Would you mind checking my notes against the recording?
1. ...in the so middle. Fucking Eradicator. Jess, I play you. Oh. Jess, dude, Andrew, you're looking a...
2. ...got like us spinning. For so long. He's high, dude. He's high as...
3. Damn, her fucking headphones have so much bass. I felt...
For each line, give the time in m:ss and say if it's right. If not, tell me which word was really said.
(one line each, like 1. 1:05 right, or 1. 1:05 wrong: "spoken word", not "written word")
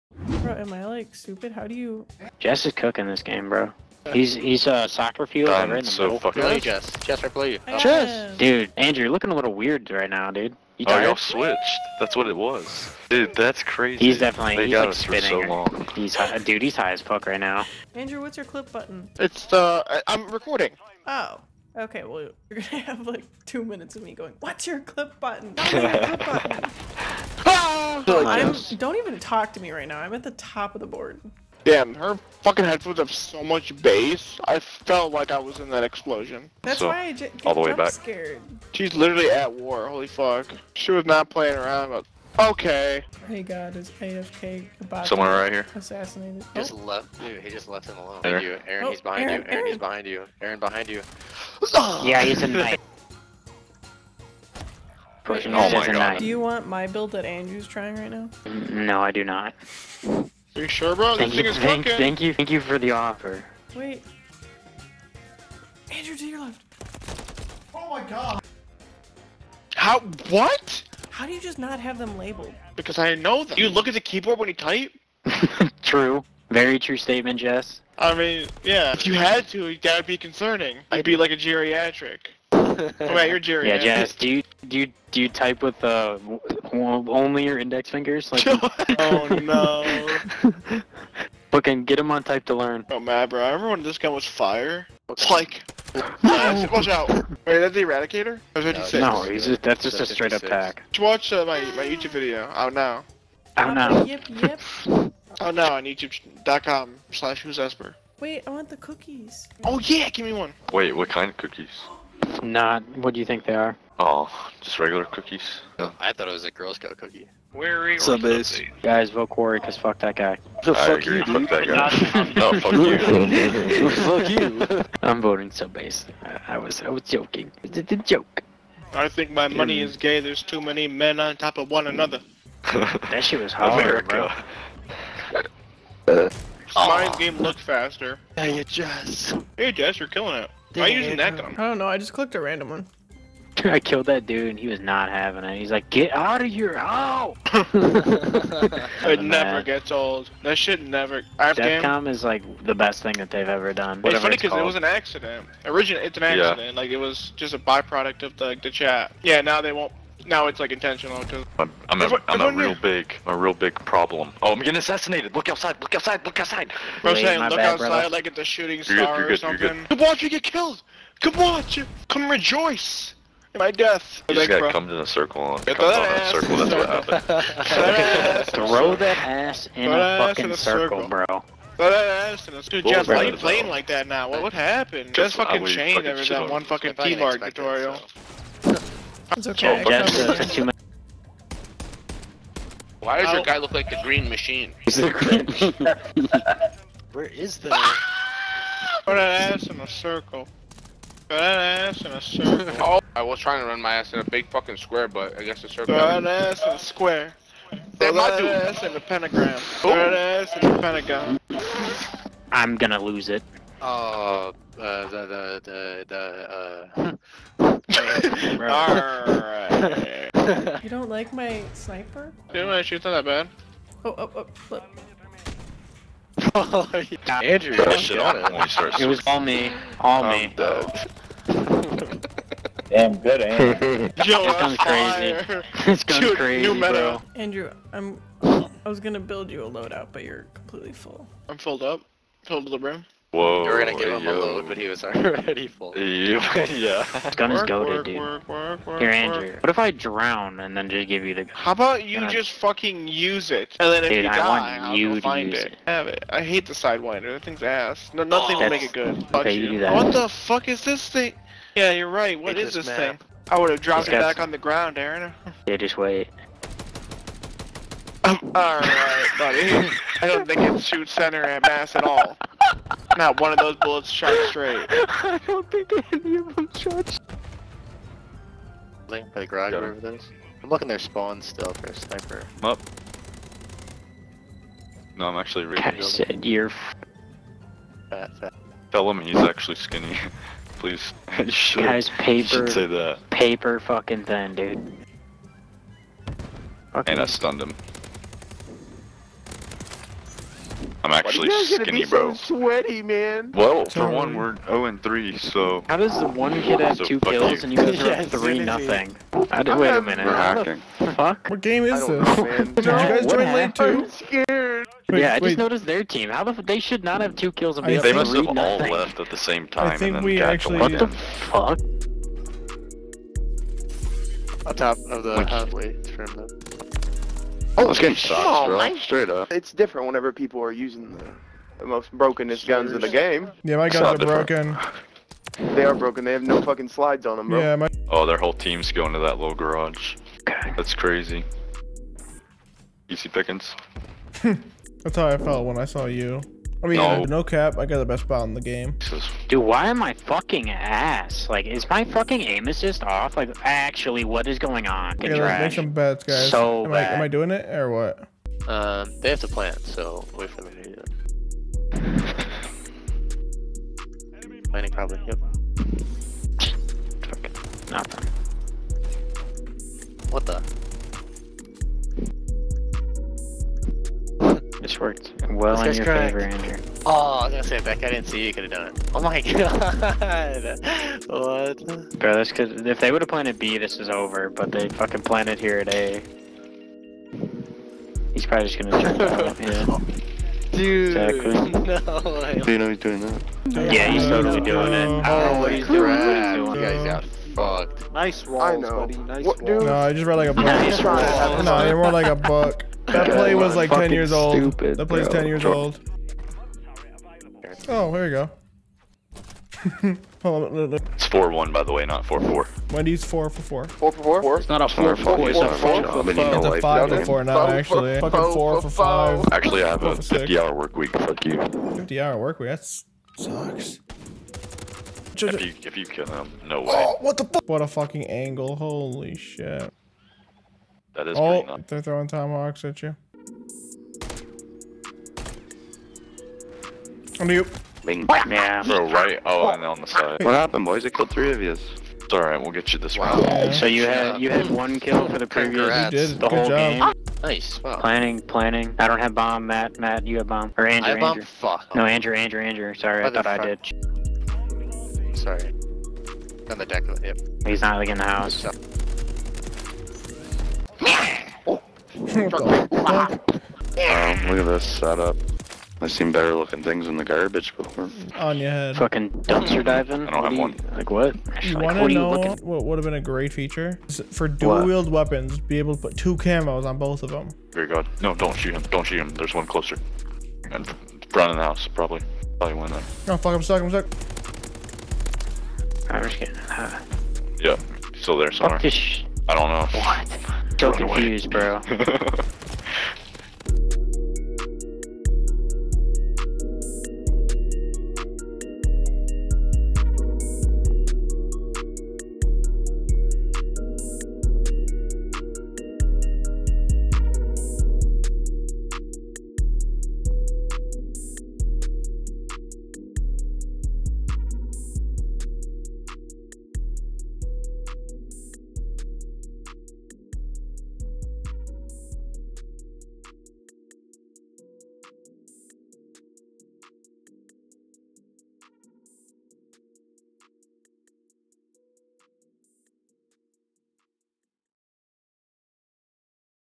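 1. 0:05 wrong: "Jess", not "Eradicator"
2. 0:14 right
3. 0:31 right.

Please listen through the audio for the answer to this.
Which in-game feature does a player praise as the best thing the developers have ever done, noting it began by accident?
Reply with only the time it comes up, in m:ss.
2:31.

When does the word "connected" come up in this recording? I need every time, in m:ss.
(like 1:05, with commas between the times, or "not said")
not said.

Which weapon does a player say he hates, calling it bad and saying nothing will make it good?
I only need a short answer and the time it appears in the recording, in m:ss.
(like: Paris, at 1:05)
Sidewinder, at 4:16.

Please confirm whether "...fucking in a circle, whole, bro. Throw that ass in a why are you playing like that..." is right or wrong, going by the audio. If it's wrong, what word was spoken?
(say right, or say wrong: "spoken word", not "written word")
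wrong: "circle", not "whole".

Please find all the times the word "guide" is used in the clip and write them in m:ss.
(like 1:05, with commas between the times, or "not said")
not said.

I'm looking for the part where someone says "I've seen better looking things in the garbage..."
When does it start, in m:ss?
7:46.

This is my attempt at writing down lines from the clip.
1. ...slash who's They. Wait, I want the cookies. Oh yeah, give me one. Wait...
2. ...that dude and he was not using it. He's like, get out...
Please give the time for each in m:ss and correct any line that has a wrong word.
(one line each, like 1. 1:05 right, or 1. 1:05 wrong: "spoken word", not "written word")
1. 1:47 wrong: "Esper", not "They"
2. 2:24 wrong: "having", not "using".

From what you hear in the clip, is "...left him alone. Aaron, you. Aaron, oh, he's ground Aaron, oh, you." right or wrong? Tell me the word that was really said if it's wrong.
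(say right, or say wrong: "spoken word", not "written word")
wrong: "behind", not "ground".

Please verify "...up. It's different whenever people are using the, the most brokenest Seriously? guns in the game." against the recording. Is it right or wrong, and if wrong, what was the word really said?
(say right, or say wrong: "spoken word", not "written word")
right.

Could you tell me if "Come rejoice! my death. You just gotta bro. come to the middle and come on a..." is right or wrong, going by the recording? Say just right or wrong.
wrong.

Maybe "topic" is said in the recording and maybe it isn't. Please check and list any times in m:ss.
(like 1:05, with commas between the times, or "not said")
not said.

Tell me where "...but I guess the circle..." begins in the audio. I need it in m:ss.
3:25.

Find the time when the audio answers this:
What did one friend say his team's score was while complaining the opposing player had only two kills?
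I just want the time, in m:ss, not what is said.
5:04.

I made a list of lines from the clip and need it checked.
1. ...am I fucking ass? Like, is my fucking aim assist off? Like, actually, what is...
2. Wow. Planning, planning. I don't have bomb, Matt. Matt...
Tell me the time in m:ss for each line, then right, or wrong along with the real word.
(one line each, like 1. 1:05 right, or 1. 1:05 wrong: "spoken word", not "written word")
1. 5:49 right
2. 7:27 right.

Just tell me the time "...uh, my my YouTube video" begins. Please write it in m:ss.
1:41.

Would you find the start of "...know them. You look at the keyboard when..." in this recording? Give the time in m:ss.
1:13.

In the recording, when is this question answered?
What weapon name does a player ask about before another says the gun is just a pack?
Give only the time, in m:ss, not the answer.
1:37.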